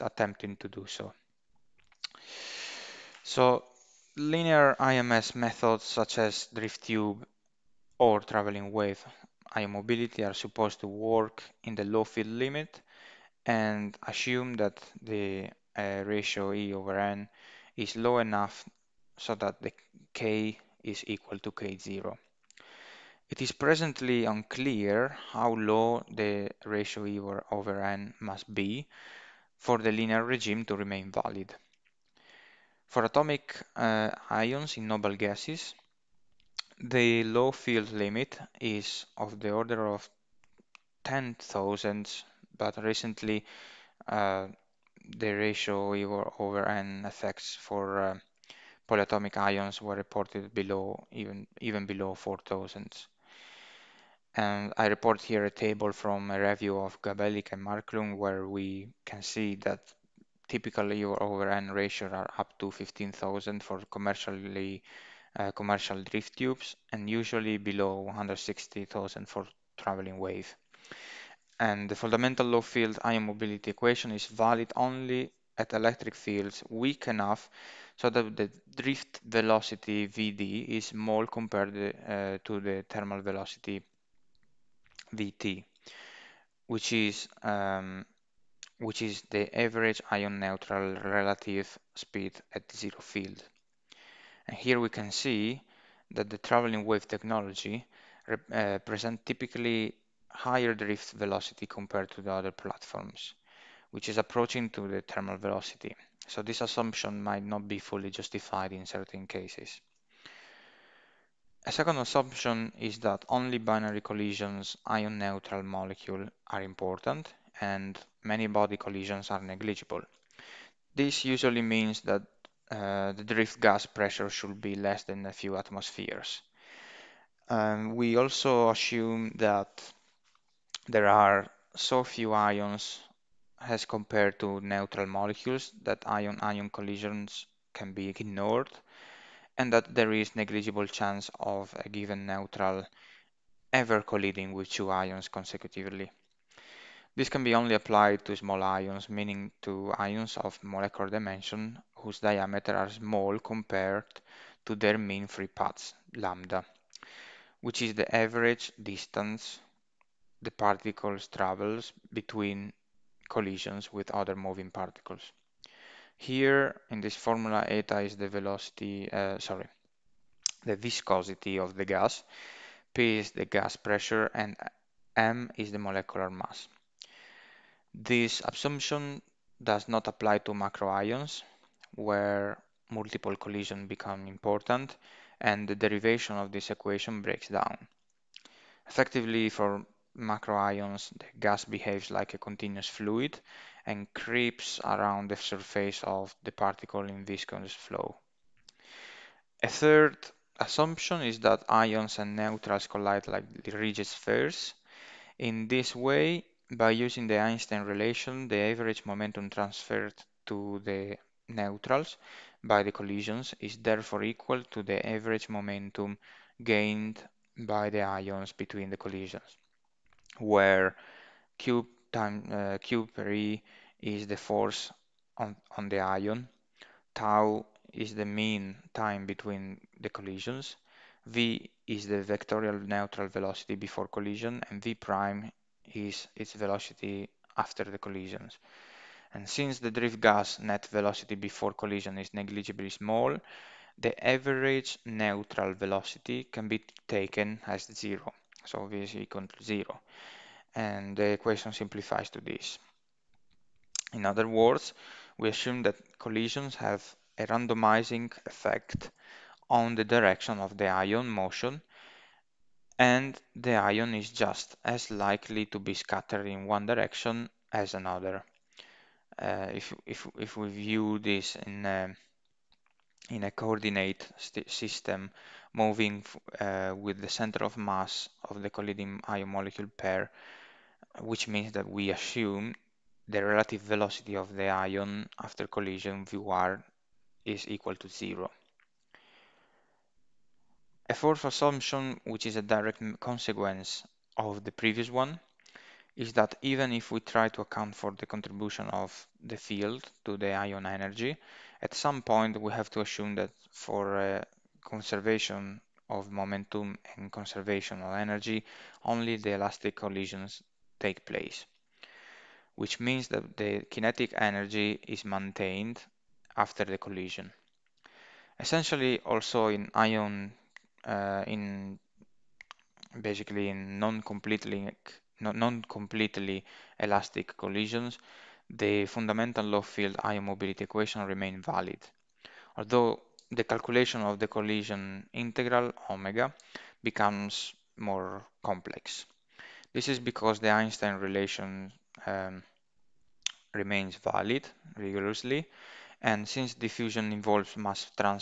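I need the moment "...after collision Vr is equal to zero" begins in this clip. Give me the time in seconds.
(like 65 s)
285 s.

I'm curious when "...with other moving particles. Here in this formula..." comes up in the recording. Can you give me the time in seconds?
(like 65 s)
163 s.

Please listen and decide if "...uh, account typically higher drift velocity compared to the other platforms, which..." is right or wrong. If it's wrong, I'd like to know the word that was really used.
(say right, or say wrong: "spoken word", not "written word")
wrong: "present", not "account".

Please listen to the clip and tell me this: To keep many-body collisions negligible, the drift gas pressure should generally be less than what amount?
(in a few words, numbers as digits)
a few atmospheres.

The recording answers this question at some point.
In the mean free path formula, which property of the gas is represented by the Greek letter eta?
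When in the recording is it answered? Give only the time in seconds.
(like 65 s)
170 s.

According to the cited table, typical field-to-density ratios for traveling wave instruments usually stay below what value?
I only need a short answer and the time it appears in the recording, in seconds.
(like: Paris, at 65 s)
160,000, at 68 s.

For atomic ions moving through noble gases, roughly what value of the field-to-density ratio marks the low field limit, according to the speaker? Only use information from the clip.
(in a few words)
10,000.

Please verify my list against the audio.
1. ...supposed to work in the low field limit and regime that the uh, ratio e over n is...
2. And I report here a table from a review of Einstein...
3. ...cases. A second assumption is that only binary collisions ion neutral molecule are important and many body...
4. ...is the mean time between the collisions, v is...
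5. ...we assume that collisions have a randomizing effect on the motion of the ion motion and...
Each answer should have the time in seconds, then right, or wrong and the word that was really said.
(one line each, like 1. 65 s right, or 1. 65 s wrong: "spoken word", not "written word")
1. 10 s wrong: "assume", not "regime"
2. 54 s wrong: "Gabelica", not "Einstein"
3. 109 s right
4. 227 s right
5. 255 s wrong: "direction", not "motion".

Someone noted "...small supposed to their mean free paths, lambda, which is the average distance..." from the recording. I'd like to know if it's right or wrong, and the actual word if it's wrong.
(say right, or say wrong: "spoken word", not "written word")
wrong: "compared", not "supposed".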